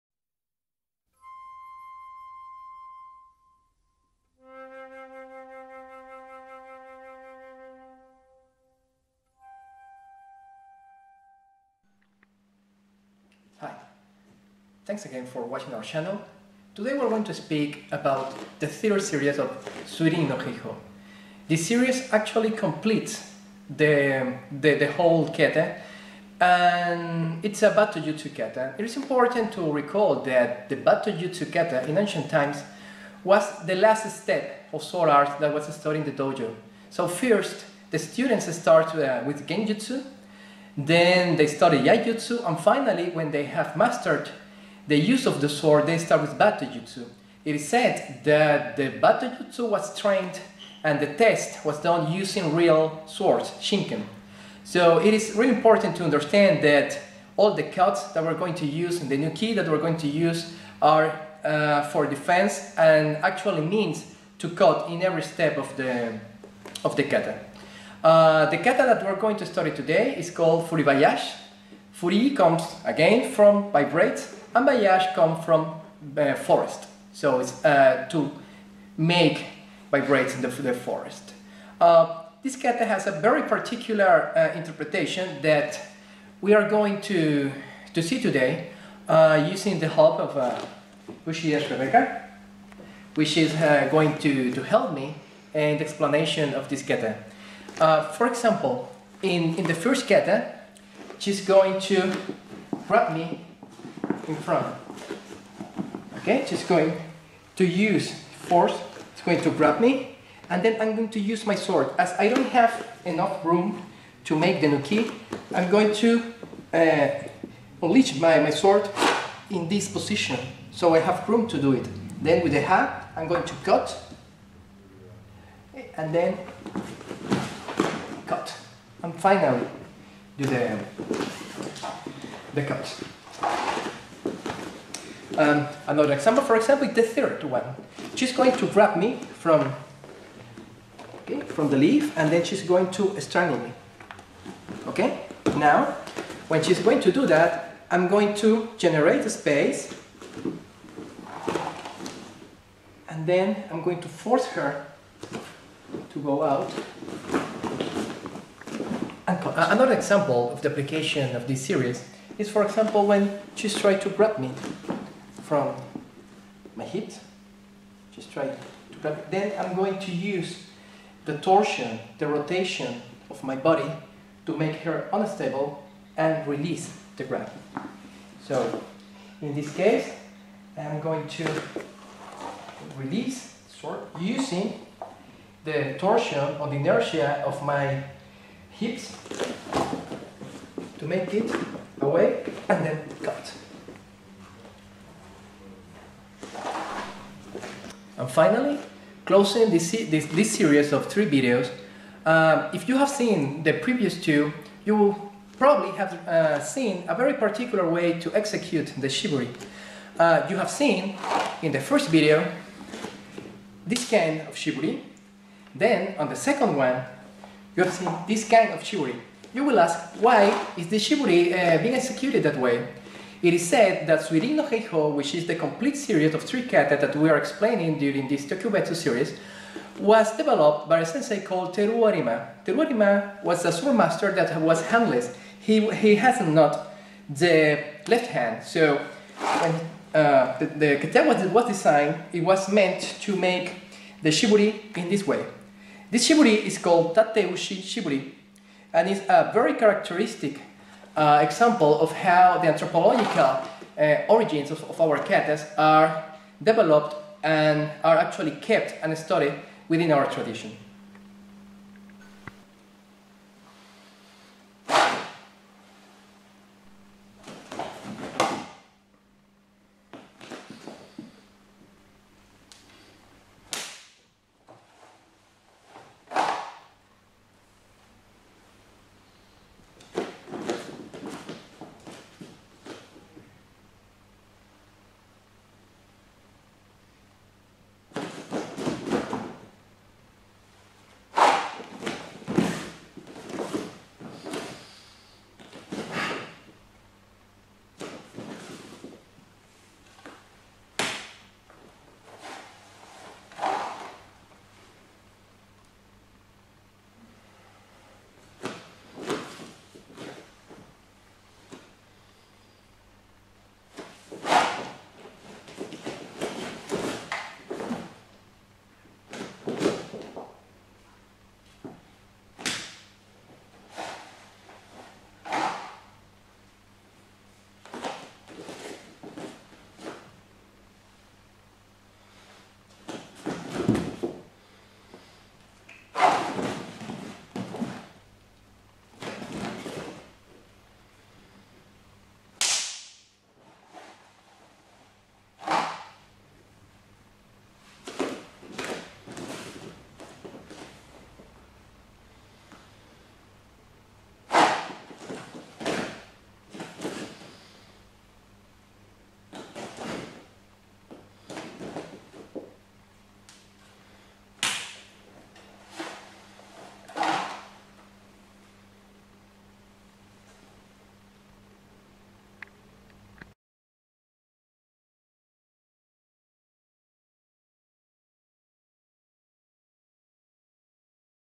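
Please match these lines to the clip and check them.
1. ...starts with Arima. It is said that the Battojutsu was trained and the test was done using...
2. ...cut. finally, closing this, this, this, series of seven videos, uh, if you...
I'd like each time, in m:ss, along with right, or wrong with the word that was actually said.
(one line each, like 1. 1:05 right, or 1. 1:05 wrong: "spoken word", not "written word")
1. 0:45 wrong: "Battojutsu", not "Arima"
2. 3:13 wrong: "three", not "seven".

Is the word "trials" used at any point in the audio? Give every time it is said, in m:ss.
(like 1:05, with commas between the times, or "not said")
not said.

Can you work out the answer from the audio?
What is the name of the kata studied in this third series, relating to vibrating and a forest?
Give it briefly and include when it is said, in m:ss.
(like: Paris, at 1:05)
Furibayashi, at 1:10.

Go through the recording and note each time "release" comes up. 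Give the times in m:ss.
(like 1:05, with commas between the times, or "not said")
2:56, 3:02.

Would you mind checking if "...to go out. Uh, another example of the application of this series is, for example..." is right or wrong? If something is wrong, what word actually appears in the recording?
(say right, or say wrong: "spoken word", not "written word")
right.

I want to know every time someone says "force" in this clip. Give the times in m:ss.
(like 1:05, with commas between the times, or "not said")
1:48, 2:34.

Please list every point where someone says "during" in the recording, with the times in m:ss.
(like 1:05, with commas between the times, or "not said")
3:47.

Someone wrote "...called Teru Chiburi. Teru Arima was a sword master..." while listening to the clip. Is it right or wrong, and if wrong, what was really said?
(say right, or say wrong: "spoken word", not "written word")
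wrong: "Arima", not "Chiburi".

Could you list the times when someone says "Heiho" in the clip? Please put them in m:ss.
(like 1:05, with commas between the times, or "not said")
0:20, 3:44.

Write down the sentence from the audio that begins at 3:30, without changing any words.
Uh, you have seen in the first video this kind of chiburi.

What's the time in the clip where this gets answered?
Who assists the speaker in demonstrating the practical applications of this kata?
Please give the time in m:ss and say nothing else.
1:31.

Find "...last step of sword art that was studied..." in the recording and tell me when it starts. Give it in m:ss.
0:33.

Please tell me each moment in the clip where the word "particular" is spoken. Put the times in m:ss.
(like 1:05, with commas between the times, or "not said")
1:23, 3:27.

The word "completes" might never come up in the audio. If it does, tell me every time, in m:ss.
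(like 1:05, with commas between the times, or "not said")
0:22, 3:45.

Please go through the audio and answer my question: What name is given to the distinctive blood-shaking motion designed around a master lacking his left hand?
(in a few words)
Tateushi Chiburi.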